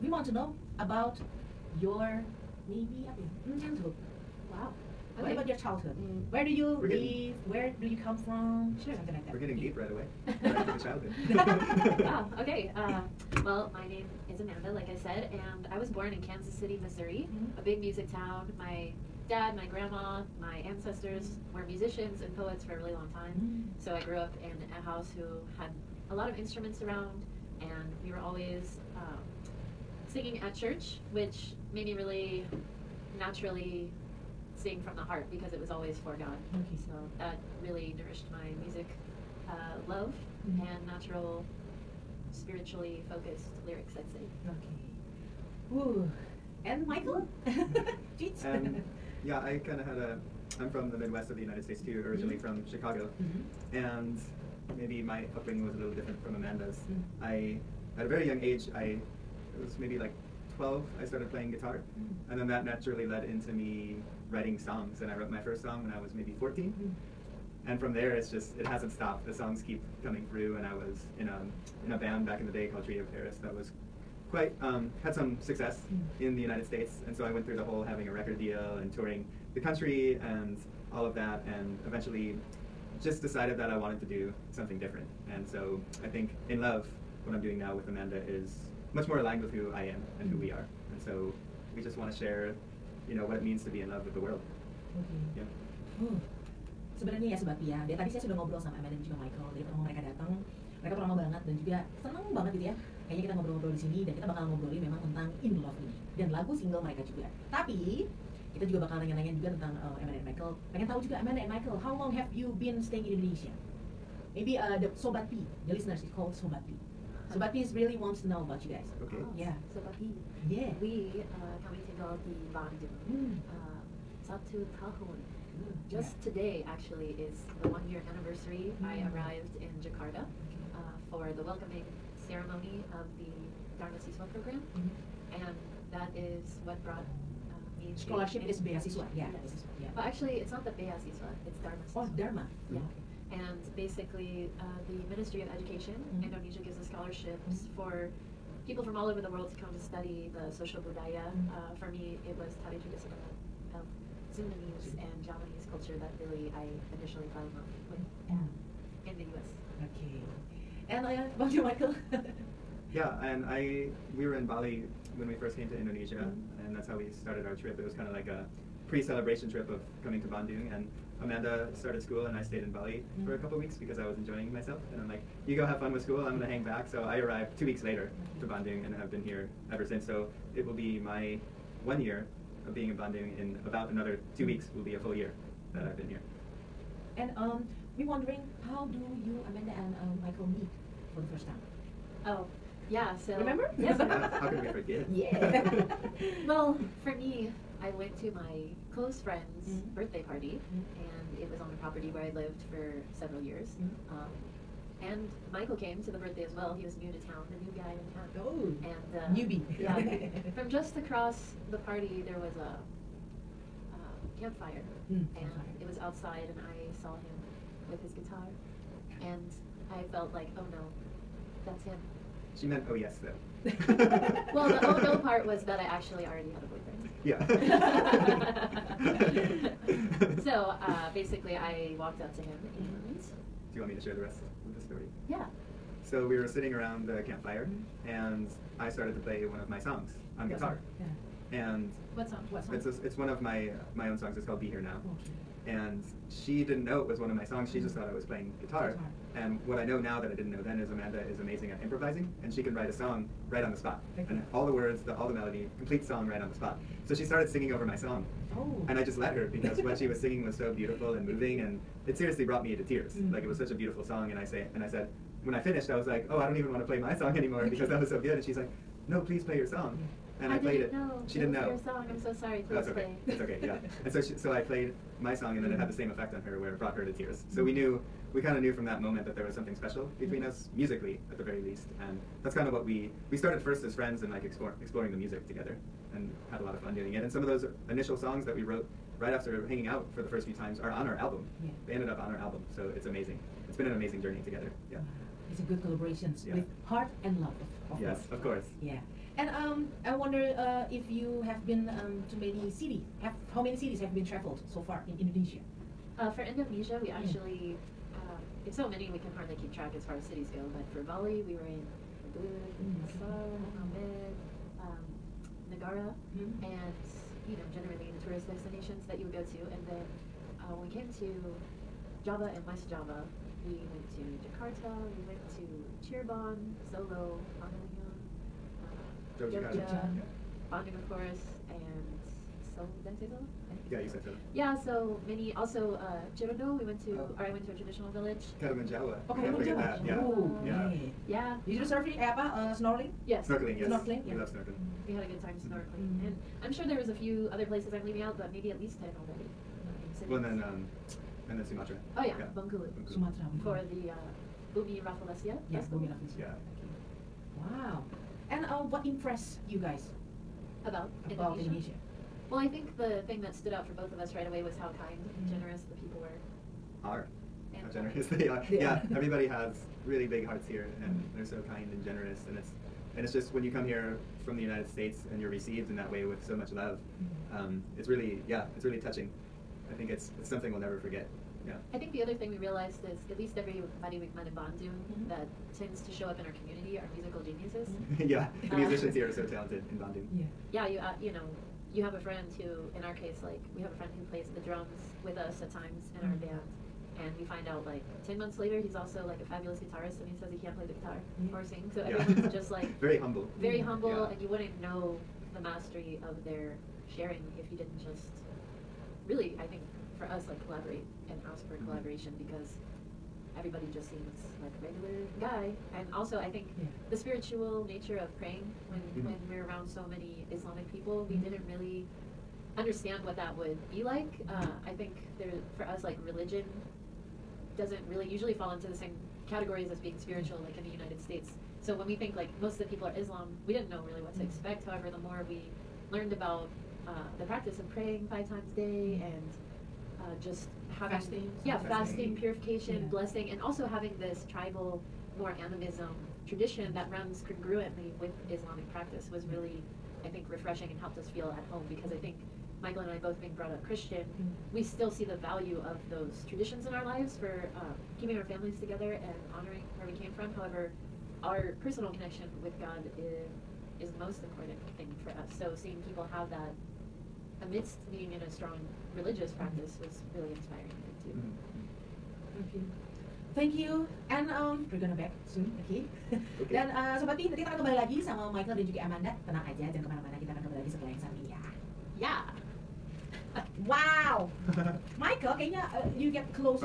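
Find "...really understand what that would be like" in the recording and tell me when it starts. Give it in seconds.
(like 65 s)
421 s.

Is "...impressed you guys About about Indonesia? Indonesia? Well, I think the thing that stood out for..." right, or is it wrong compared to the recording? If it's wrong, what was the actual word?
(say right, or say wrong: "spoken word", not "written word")
right.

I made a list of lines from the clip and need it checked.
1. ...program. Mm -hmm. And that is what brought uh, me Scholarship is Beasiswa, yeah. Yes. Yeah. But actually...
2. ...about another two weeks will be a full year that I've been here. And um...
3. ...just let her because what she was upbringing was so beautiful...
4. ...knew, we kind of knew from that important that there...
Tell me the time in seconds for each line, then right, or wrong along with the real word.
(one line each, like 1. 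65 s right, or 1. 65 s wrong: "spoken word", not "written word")
1. 134 s right
2. 183 s right
3. 259 s wrong: "singing", not "upbringing"
4. 277 s wrong: "moment", not "important".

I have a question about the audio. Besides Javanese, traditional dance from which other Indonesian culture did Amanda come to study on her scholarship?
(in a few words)
Sundanese.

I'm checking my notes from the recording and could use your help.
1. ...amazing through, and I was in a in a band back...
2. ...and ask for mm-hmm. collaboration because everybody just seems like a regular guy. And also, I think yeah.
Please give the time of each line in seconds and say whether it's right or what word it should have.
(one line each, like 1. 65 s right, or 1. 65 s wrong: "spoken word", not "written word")
1. 70 s wrong: "coming", not "amazing"
2. 411 s right.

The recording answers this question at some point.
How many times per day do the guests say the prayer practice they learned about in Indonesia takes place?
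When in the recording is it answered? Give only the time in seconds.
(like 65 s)
438 s.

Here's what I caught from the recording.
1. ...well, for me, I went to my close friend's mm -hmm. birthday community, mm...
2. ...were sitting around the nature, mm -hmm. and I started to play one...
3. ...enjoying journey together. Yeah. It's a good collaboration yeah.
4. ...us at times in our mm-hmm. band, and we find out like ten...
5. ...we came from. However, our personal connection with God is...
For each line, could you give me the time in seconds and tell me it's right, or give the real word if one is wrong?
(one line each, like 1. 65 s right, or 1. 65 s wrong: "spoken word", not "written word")
1. 196 s wrong: "party", not "community"
2. 236 s wrong: "campfire", not "nature"
3. 293 s wrong: "amazing", not "enjoying"
4. 395 s right
5. 460 s right.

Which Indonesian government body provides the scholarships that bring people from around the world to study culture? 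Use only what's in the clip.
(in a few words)
Ministry of Education.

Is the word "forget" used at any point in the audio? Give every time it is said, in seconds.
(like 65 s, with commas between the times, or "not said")
194 s, 381 s.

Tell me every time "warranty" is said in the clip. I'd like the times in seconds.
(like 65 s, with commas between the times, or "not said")
not said.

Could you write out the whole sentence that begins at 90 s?
And so we just want to share, you know, what it means to be in love with the world.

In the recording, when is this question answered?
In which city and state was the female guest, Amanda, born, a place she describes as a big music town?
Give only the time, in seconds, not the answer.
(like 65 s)
16 s.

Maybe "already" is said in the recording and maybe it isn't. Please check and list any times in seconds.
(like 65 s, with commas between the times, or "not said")
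226 s, 349 s.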